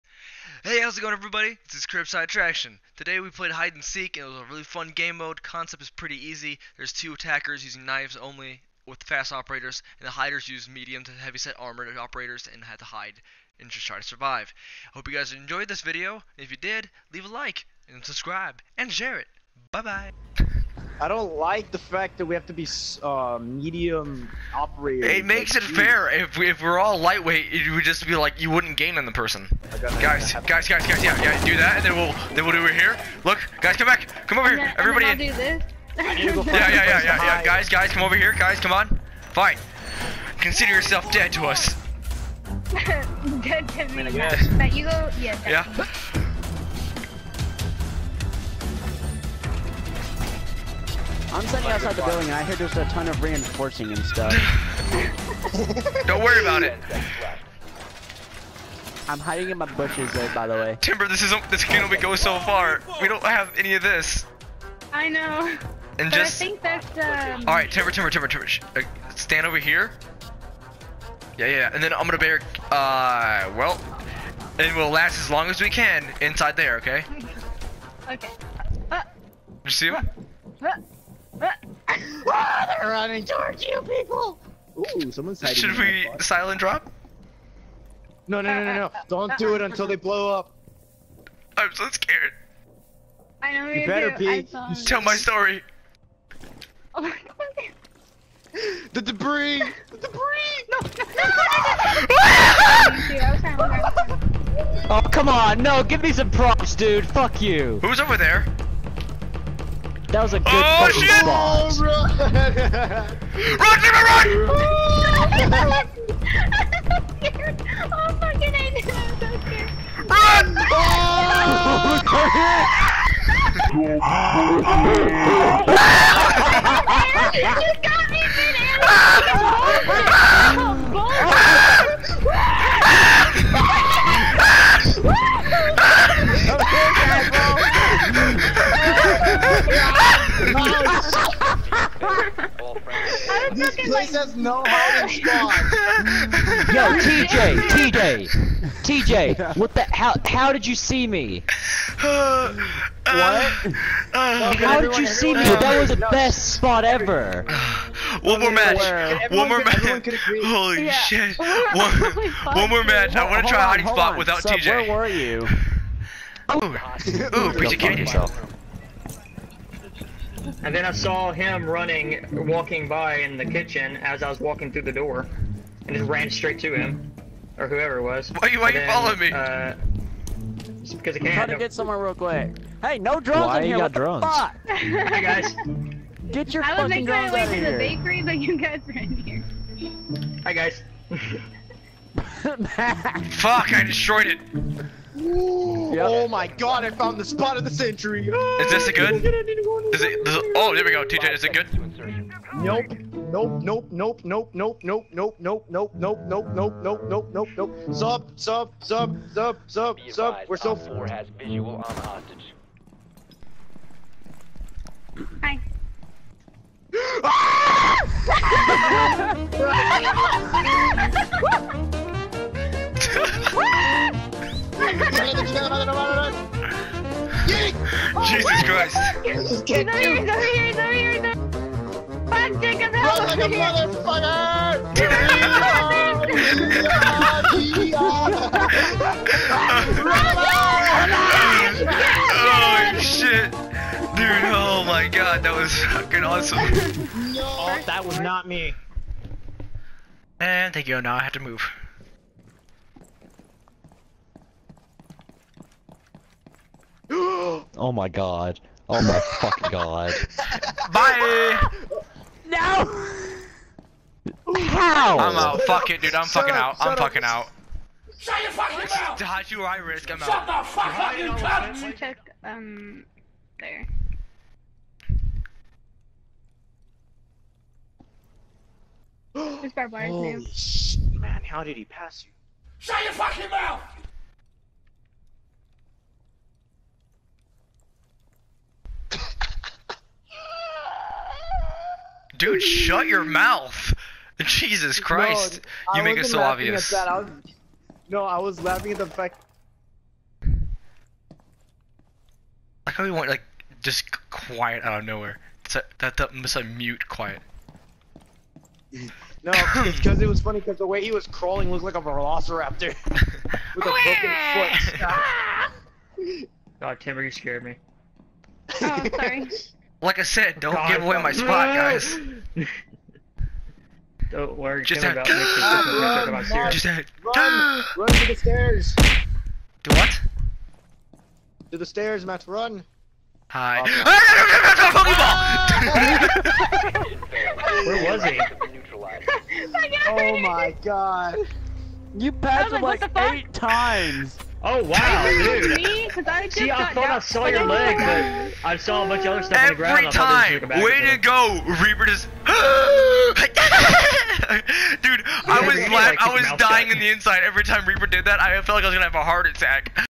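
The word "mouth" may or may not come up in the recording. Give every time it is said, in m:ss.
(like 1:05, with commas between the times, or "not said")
4:28, 4:43, 4:53.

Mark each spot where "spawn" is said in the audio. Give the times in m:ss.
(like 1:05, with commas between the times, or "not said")
not said.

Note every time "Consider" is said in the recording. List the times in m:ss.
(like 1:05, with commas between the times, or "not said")
0:40.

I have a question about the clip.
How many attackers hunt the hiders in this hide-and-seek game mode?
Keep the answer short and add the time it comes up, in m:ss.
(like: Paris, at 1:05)
2, at 0:06.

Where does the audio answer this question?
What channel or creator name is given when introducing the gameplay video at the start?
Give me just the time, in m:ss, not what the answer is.
0:01.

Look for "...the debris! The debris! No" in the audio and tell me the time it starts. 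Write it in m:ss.
1:38.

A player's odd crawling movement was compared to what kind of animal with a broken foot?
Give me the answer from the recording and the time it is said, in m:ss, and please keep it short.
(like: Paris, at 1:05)
A velociraptor, at 5:12.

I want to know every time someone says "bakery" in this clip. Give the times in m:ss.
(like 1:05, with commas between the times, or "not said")
3:07.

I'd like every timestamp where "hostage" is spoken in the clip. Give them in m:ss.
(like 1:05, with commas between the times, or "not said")
3:31.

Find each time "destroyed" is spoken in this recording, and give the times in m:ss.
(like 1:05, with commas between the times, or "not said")
3:13.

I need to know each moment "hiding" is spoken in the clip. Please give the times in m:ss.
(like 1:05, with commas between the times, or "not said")
0:59, 1:25, 2:24, 2:43.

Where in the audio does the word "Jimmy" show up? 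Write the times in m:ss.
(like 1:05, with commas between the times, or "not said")
1:53.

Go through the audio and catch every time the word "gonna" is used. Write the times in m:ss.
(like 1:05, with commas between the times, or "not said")
1:12, 5:58.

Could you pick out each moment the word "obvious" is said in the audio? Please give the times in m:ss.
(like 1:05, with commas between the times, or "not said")
4:56.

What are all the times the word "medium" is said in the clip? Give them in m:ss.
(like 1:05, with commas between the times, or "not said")
0:10, 0:23.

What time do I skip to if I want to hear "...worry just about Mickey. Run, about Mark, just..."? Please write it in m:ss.
5:24.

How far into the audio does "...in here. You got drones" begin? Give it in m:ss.
3:03.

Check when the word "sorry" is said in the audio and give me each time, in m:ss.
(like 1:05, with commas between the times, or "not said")
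5:19.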